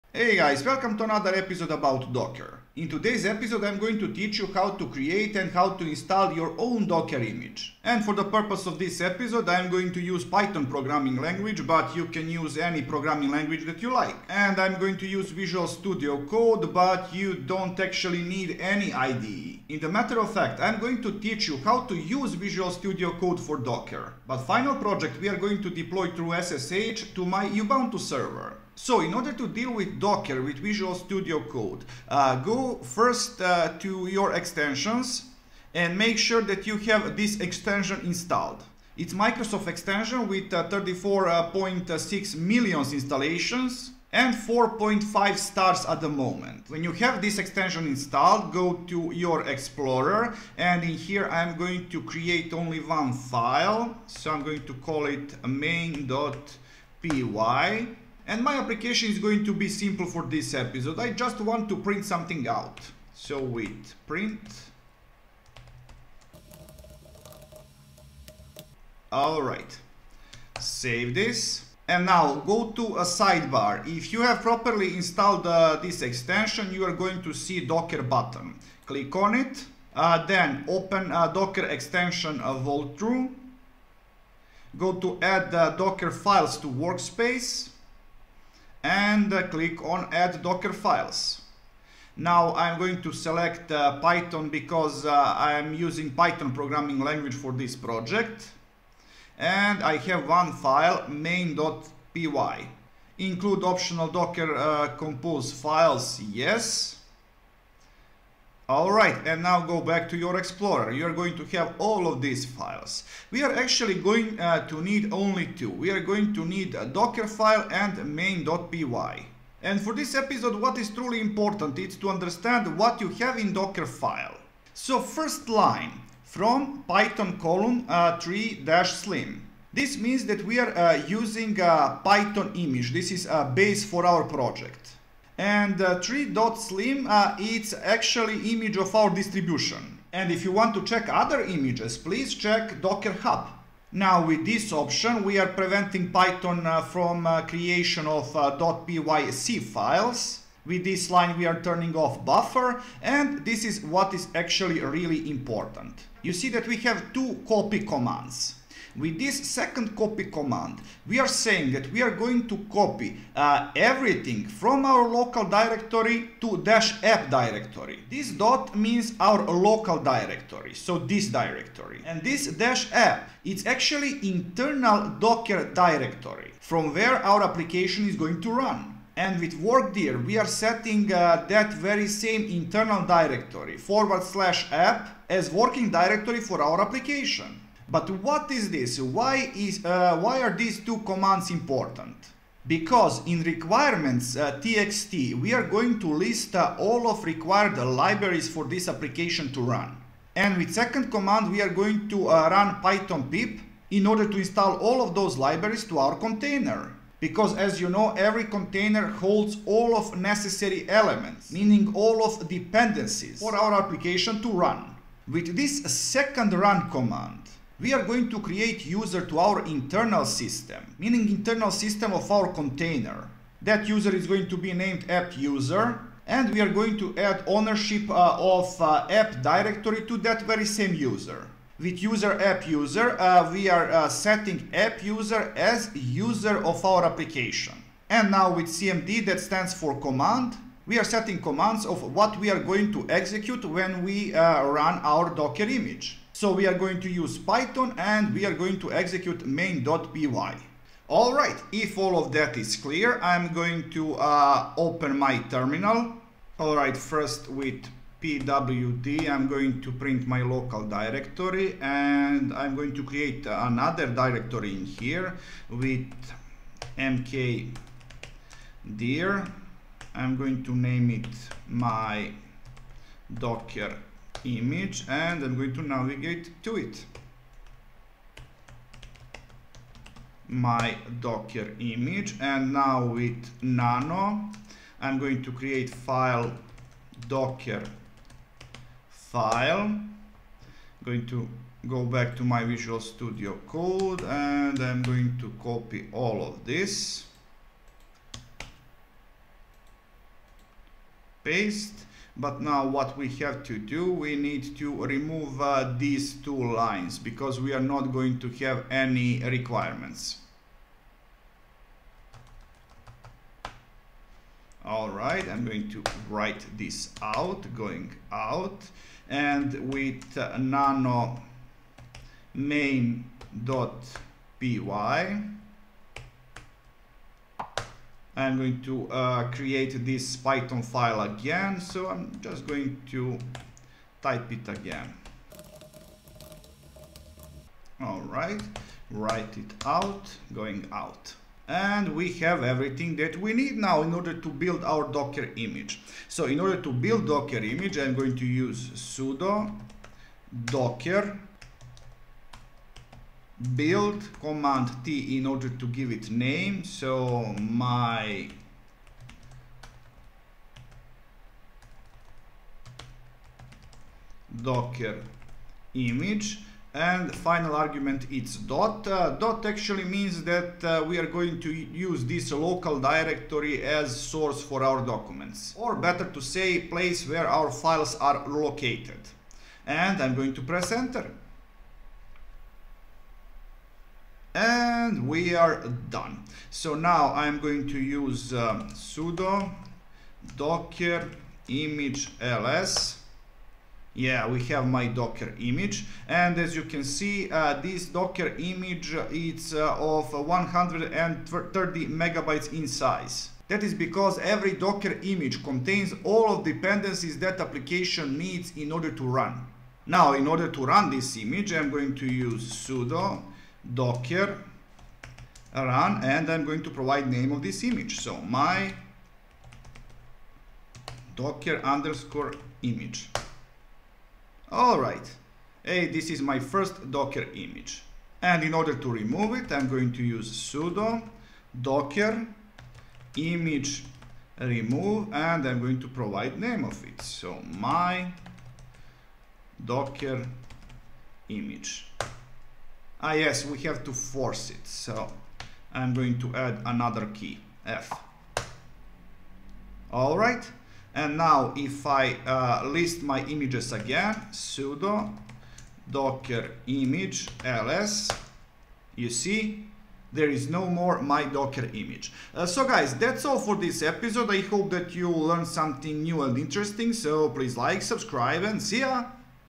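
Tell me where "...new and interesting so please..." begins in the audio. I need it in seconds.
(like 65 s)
466 s.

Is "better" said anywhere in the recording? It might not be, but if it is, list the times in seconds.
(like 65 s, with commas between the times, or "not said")
375 s.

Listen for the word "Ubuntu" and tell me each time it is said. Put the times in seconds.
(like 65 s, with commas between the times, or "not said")
27 s.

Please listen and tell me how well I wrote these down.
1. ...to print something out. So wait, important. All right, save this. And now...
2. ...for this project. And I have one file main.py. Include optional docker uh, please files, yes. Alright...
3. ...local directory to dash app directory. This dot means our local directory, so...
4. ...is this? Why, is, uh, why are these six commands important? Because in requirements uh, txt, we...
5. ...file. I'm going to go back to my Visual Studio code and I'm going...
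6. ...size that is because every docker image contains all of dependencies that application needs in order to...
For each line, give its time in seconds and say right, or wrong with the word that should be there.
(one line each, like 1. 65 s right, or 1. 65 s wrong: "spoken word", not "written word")
1. 61 s wrong: "print", not "important"
2. 97 s wrong: "compose", not "please"
3. 165 s right
4. 188 s wrong: "two", not "six"
5. 289 s right
6. 402 s right.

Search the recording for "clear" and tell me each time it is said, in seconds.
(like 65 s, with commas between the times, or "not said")
252 s.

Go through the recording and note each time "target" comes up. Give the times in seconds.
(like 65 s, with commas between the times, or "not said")
not said.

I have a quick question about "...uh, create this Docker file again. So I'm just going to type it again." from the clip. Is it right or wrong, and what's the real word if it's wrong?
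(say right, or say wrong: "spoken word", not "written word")
wrong: "Python", not "Docker".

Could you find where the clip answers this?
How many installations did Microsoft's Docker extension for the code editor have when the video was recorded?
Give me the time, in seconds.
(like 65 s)
40 s.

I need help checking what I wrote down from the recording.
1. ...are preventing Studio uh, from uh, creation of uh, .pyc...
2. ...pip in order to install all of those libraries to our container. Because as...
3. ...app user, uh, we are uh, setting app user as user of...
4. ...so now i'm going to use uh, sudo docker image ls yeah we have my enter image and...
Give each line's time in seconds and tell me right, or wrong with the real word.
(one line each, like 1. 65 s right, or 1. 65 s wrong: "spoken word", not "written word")
1. 145 s wrong: "Python", not "Studio"
2. 203 s right
3. 232 s right
4. 386 s wrong: "docker", not "enter".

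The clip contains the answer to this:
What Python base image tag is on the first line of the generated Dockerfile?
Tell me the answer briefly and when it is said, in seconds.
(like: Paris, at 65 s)
python:3-slim, at 126 s.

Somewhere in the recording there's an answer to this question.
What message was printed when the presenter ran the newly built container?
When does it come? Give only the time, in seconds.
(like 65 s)
425 s.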